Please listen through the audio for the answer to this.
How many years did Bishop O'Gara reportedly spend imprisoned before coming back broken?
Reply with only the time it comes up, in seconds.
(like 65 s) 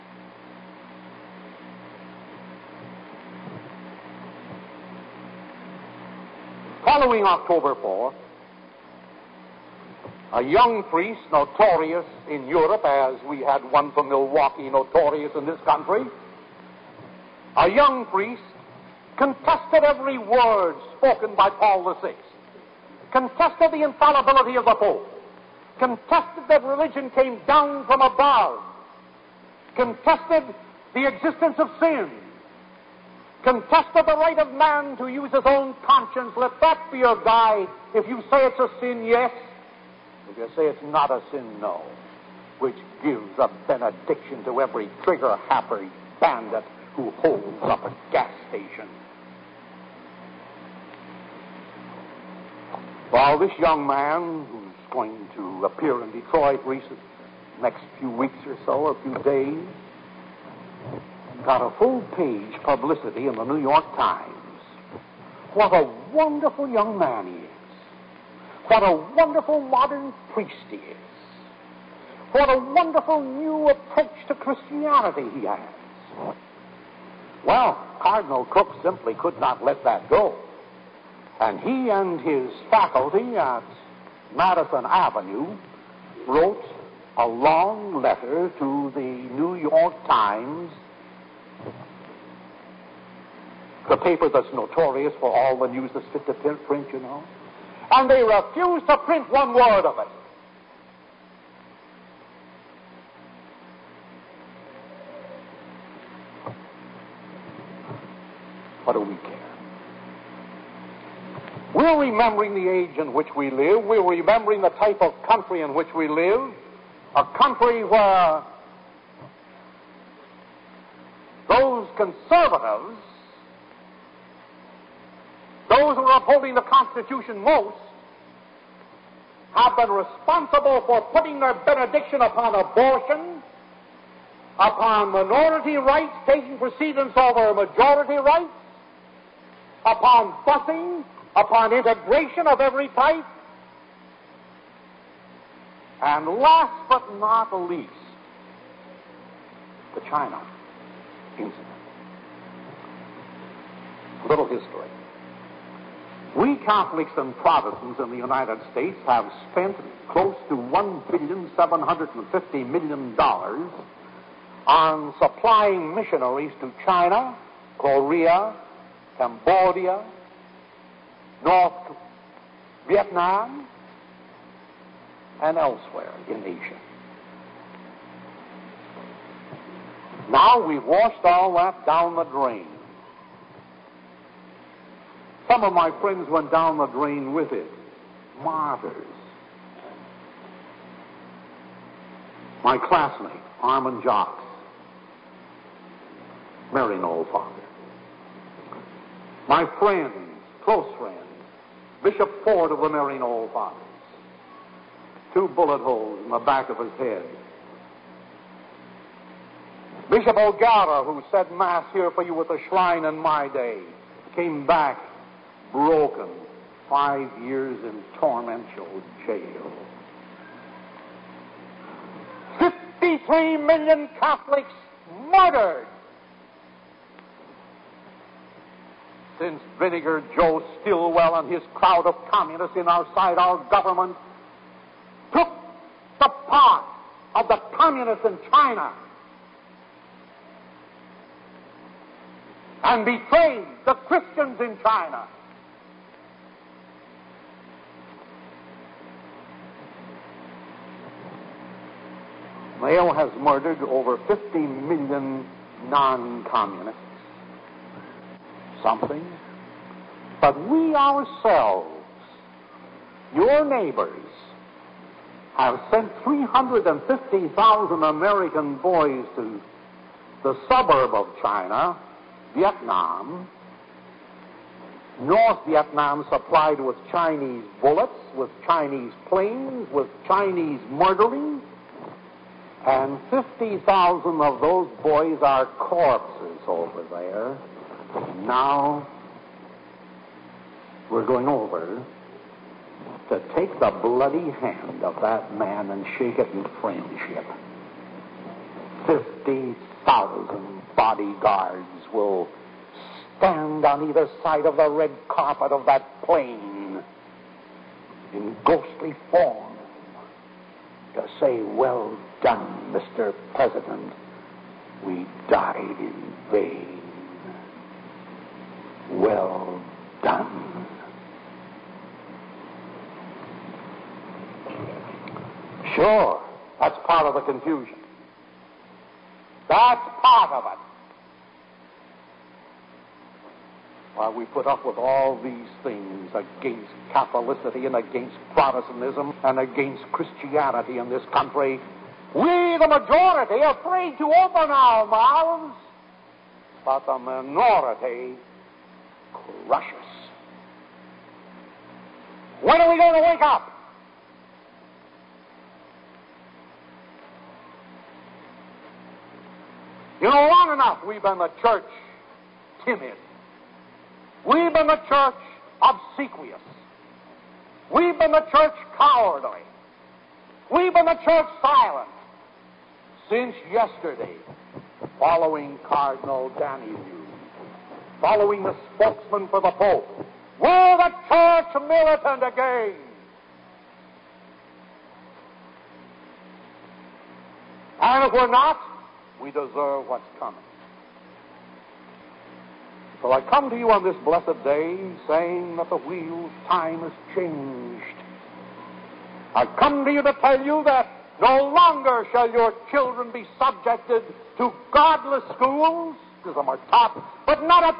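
216 s.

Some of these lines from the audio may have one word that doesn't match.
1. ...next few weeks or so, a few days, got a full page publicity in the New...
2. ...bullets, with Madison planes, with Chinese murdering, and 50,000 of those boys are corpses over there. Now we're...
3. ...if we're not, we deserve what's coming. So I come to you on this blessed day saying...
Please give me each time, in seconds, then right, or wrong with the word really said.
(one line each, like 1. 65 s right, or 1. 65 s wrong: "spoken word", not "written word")
1. 57 s right
2. 277 s wrong: "Chinese", not "Madison"
3. 388 s right.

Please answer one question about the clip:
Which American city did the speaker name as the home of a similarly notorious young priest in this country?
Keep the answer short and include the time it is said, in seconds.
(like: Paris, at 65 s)
Milwaukee, at 14 s.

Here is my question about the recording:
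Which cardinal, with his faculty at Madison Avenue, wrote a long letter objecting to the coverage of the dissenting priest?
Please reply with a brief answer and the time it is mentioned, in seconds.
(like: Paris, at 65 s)
Cardinal Cooke, at 78 s.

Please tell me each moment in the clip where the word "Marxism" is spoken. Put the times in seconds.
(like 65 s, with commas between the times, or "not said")
406 s.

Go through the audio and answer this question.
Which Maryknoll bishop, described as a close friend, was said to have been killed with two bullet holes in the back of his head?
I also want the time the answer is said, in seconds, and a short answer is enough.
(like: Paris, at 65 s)
Bishop Ford, at 202 s.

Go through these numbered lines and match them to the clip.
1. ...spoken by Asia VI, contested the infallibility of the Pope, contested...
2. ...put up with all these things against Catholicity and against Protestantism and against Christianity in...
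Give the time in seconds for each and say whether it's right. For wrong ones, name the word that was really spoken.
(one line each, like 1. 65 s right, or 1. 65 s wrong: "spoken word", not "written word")
1. 20 s wrong: "Paul", not "Asia"
2. 334 s right.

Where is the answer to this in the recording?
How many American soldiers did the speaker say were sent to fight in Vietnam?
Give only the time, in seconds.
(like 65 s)
266 s.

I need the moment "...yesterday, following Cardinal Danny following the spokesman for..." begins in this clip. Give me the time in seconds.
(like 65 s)
373 s.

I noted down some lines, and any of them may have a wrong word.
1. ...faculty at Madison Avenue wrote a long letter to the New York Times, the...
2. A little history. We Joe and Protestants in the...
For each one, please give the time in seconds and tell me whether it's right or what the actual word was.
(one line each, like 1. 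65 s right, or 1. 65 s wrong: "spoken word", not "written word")
1. 82 s right
2. 154 s wrong: "Catholics", not "Joe".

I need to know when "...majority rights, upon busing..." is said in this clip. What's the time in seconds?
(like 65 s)
137 s.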